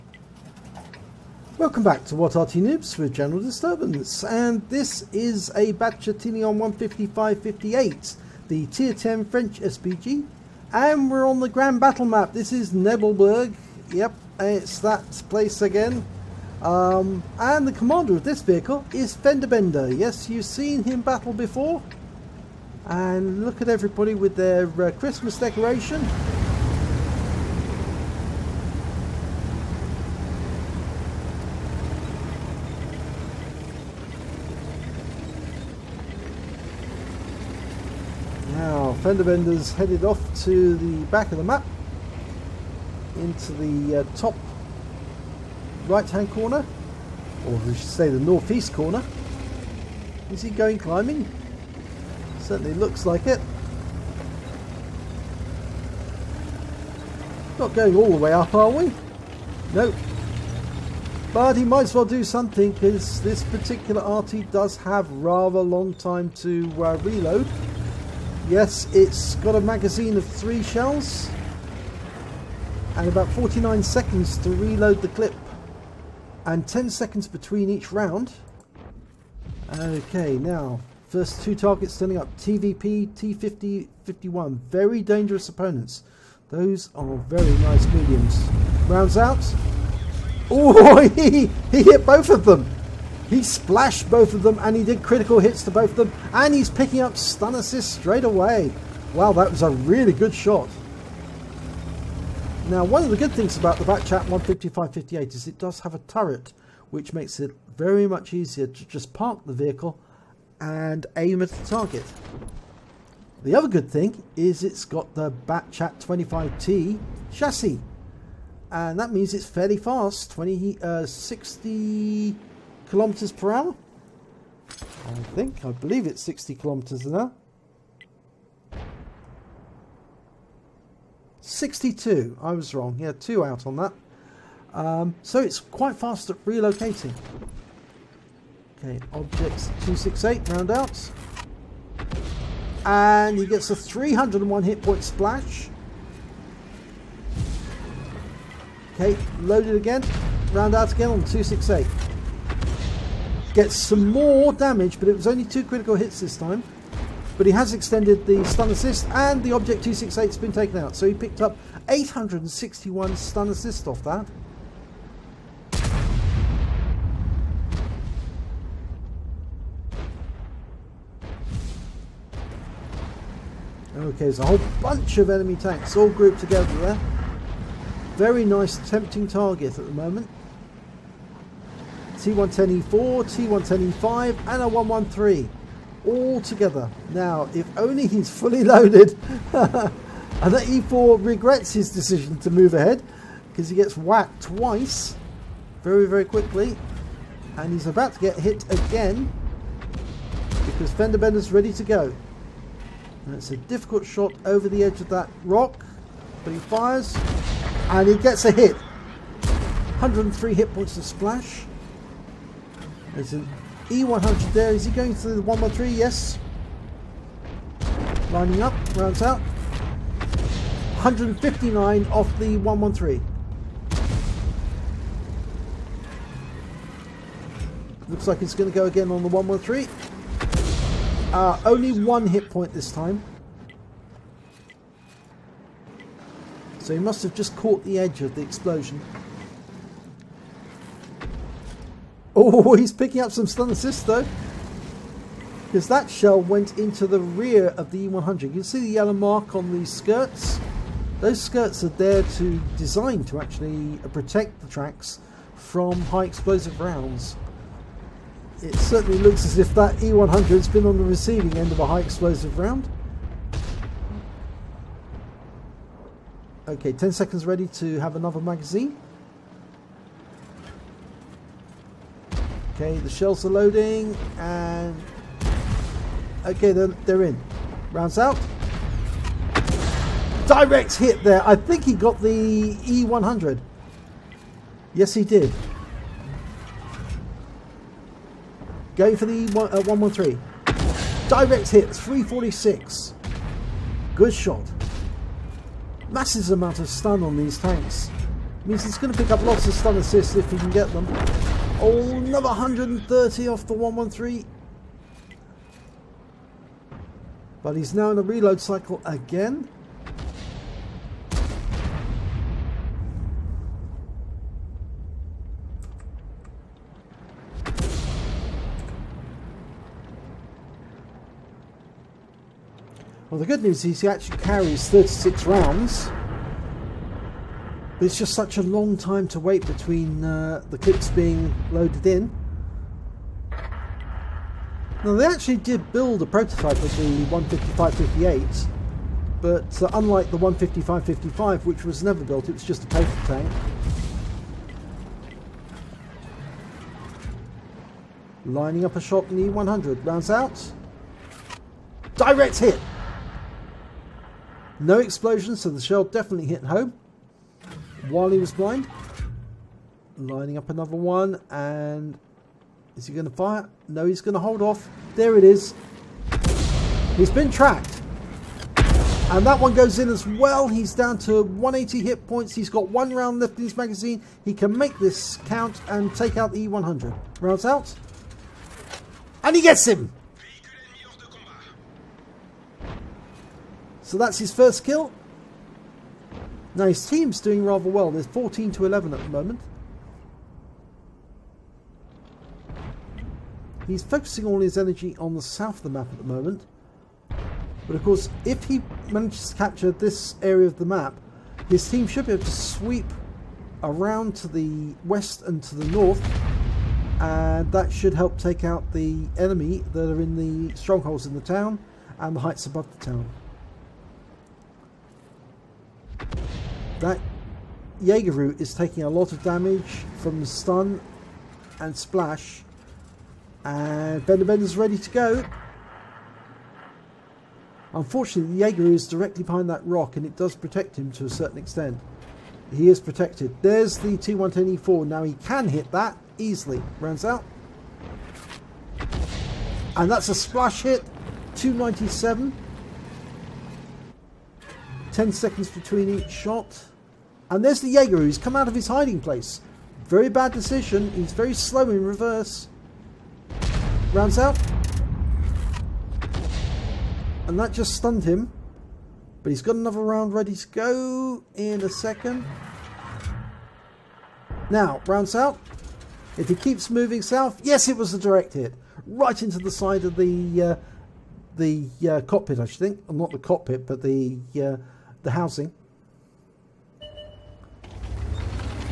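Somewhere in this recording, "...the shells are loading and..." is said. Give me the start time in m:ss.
4:32.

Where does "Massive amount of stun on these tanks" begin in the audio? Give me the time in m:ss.
4:56.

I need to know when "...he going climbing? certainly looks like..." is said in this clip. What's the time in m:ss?
0:50.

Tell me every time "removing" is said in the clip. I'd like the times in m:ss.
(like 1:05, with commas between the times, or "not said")
not said.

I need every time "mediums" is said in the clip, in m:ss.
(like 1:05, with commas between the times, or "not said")
1:27.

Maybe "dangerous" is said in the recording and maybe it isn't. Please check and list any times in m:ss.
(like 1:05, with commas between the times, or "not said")
1:25.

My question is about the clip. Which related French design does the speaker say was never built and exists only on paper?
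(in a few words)
15555.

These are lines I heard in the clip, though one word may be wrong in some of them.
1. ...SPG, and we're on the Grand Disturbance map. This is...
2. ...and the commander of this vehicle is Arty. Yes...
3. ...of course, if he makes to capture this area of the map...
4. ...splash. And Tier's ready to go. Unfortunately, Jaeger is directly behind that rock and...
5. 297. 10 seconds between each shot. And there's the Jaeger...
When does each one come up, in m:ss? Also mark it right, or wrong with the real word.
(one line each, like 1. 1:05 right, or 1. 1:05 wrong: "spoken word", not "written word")
1. 0:09 wrong: "Battle", not "Disturbance"
2. 0:17 wrong: "FendaBenda", not "Arty"
3. 6:37 wrong: "manages", not "makes"
4. 7:01 wrong: "FendaBenda", not "Tier"
5. 7:21 right.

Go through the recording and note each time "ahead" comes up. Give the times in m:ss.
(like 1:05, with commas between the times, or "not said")
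3:12.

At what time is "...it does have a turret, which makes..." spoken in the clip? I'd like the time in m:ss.
1:45.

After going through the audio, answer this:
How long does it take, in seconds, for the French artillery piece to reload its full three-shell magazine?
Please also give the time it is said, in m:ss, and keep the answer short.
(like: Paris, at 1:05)
49 seconds, at 1:13.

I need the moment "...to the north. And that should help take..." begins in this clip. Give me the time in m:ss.
6:45.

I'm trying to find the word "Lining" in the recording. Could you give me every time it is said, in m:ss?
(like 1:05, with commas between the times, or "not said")
3:38, 5:48, 6:00.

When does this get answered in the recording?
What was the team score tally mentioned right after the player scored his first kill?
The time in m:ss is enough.
6:28.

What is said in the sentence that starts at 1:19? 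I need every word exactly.
Okay, now, first two targets standing up, TVP, T50, 51.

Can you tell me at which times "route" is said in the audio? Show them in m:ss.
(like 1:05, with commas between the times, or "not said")
not said.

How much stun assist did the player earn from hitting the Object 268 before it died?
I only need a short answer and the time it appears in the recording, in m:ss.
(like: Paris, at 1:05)
861, at 2:41.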